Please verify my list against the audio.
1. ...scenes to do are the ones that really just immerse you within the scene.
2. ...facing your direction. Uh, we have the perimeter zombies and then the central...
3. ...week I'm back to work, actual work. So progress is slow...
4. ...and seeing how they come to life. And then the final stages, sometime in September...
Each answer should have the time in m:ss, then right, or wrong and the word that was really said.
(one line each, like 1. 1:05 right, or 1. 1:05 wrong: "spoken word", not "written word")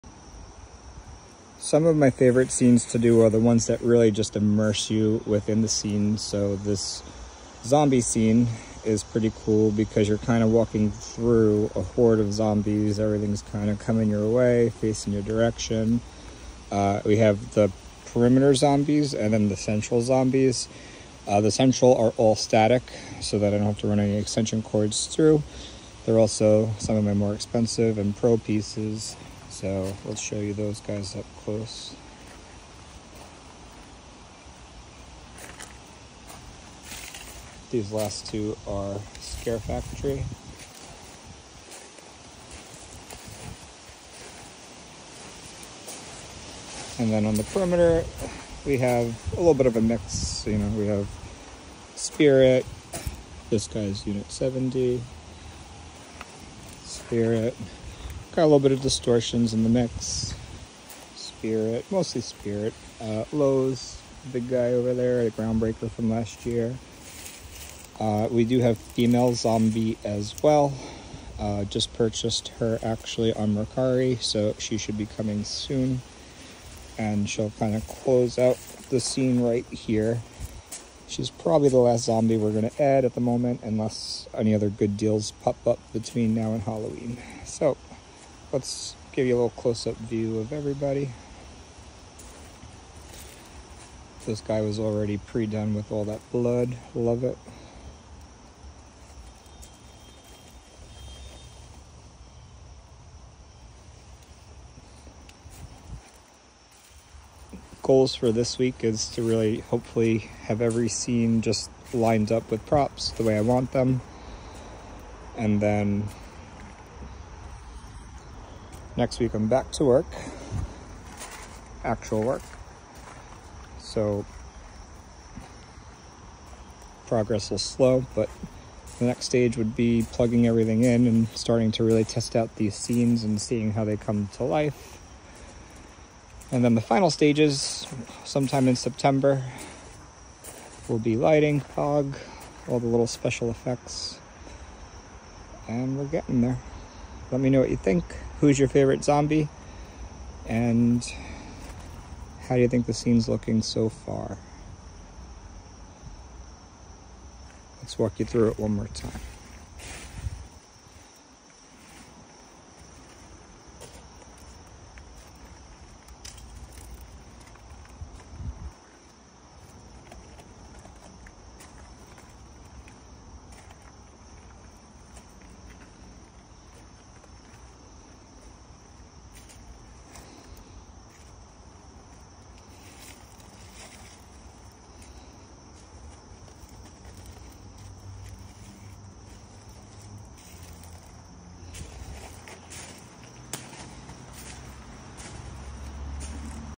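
1. 0:02 right
2. 0:14 right
3. 1:59 right
4. 2:13 right.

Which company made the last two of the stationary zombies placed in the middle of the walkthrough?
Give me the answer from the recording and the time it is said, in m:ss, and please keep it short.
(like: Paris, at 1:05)
Scare Factory, at 0:39.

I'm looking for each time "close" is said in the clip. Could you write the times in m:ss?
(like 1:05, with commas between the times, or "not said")
0:31, 1:17, 1:29.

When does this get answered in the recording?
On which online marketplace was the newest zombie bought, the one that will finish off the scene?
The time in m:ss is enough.
1:13.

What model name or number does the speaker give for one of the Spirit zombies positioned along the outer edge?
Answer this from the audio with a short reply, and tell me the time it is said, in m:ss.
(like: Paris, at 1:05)
Unit 70, at 0:54.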